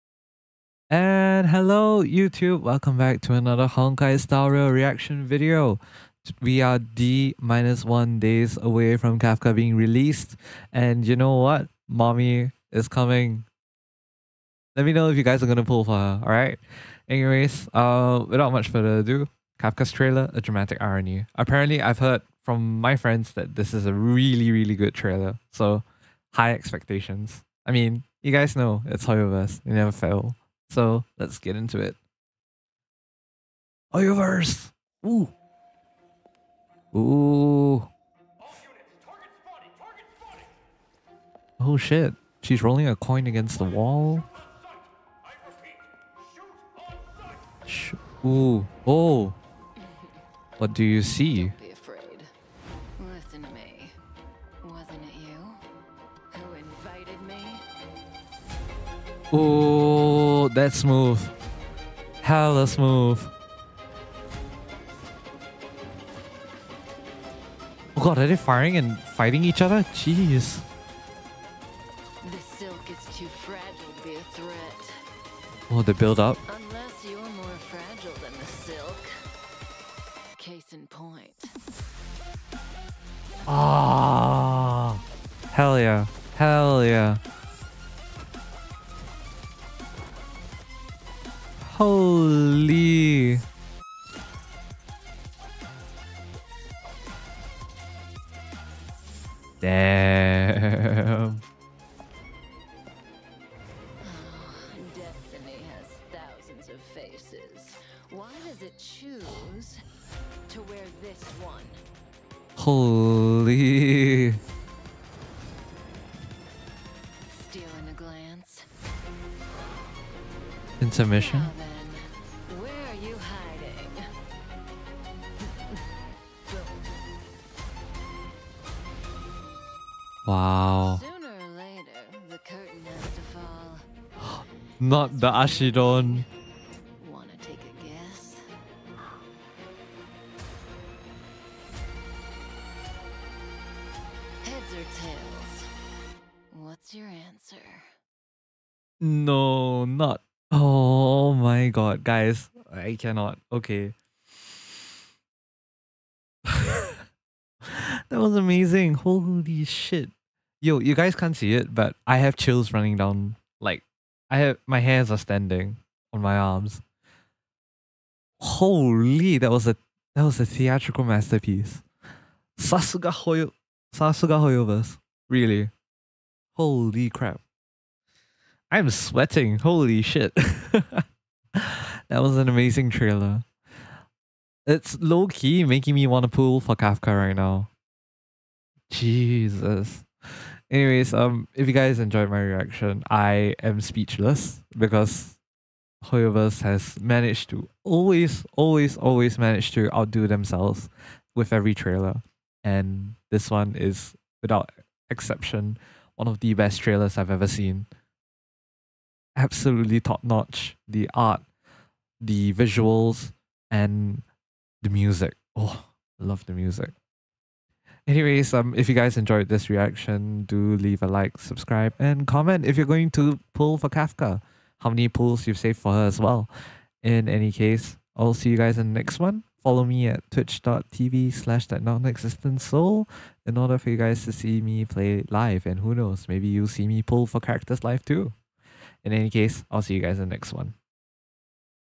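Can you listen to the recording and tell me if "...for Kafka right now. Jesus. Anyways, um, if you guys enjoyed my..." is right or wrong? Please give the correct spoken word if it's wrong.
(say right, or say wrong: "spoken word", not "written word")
right.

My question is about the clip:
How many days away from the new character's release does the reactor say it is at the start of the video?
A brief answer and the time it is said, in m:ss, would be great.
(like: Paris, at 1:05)
1, at 0:06.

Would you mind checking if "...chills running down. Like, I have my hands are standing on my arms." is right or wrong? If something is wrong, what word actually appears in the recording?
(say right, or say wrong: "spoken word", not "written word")
right.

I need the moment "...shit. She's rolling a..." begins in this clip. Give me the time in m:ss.
0:41.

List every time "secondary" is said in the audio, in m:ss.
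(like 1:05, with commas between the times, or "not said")
not said.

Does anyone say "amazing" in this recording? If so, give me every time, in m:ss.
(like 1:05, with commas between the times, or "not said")
2:38, 3:02.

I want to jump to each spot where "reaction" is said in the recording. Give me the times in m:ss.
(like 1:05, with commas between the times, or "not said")
0:04, 3:12, 3:39.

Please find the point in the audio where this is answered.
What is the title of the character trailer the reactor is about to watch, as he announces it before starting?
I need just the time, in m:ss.
0:20.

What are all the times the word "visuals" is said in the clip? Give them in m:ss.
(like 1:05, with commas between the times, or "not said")
3:32.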